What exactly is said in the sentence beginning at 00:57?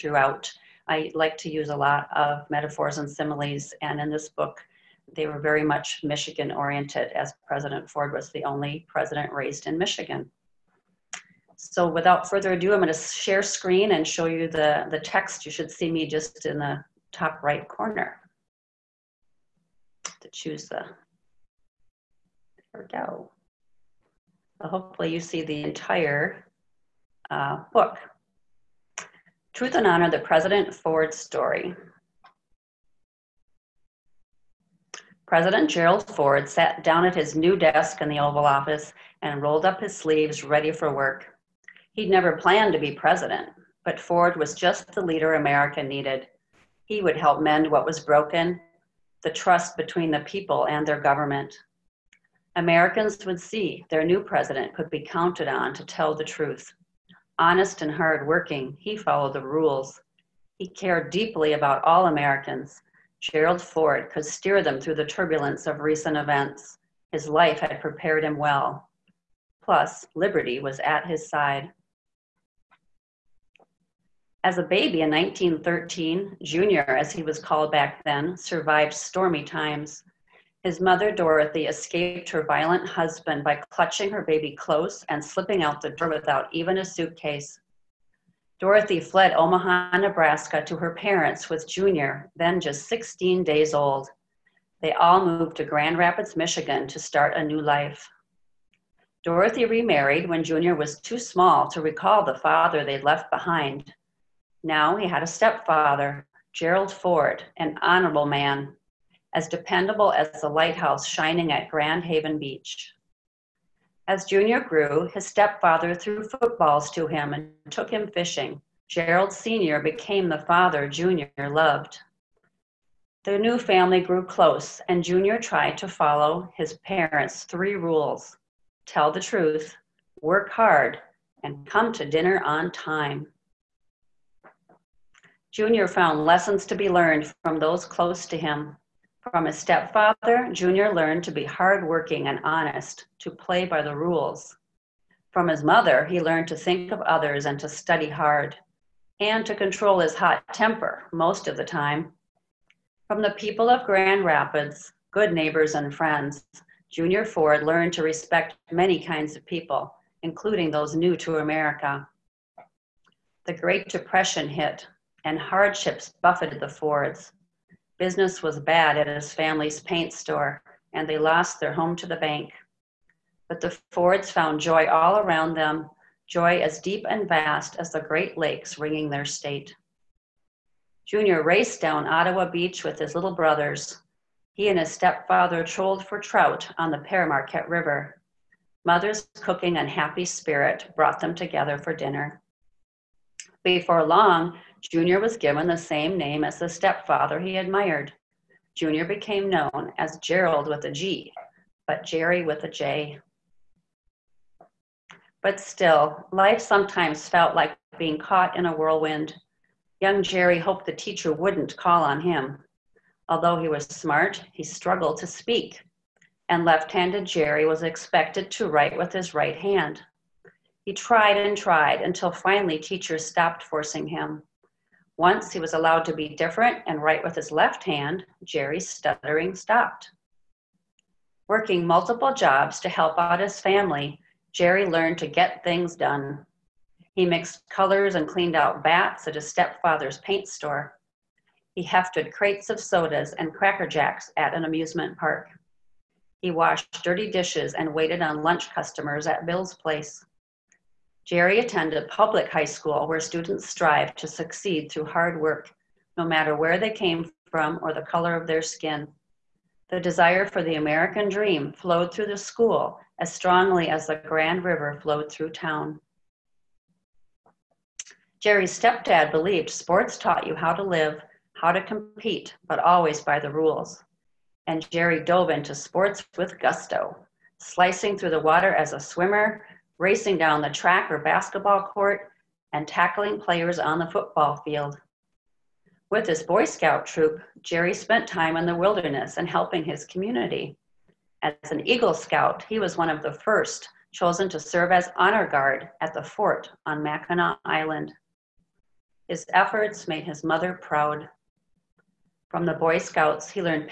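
Honest and hard working, he followed the rules.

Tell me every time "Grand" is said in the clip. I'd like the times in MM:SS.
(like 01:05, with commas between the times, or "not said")
01:35, 01:51, 02:33, 04:24.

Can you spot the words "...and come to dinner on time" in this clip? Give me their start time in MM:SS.
02:11.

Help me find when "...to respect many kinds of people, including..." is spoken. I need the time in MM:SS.
02:37.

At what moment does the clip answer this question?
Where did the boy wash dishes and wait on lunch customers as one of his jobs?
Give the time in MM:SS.
04:09.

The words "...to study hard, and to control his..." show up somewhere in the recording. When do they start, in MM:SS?
02:27.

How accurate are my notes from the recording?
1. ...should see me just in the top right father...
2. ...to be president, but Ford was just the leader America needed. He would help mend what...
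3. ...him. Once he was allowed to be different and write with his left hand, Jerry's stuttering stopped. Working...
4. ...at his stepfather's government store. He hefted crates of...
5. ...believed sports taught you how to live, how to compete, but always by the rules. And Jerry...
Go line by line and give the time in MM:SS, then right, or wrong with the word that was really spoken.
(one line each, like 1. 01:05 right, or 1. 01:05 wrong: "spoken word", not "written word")
1. 00:15 wrong: "corner", not "father"
2. 00:42 right
3. 03:44 right
4. 03:59 wrong: "paint", not "government"
5. 04:29 right.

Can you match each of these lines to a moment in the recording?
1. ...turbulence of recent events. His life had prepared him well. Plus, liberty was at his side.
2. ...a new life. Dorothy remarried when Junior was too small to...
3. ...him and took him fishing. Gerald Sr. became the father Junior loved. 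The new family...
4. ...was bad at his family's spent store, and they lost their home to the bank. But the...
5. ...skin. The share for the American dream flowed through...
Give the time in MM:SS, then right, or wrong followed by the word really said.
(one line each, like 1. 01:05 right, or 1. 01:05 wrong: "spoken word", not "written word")
1. 01:05 right
2. 01:37 right
3. 01:57 right
4. 02:48 wrong: "paint", not "spent"
5. 04:18 wrong: "desire", not "share".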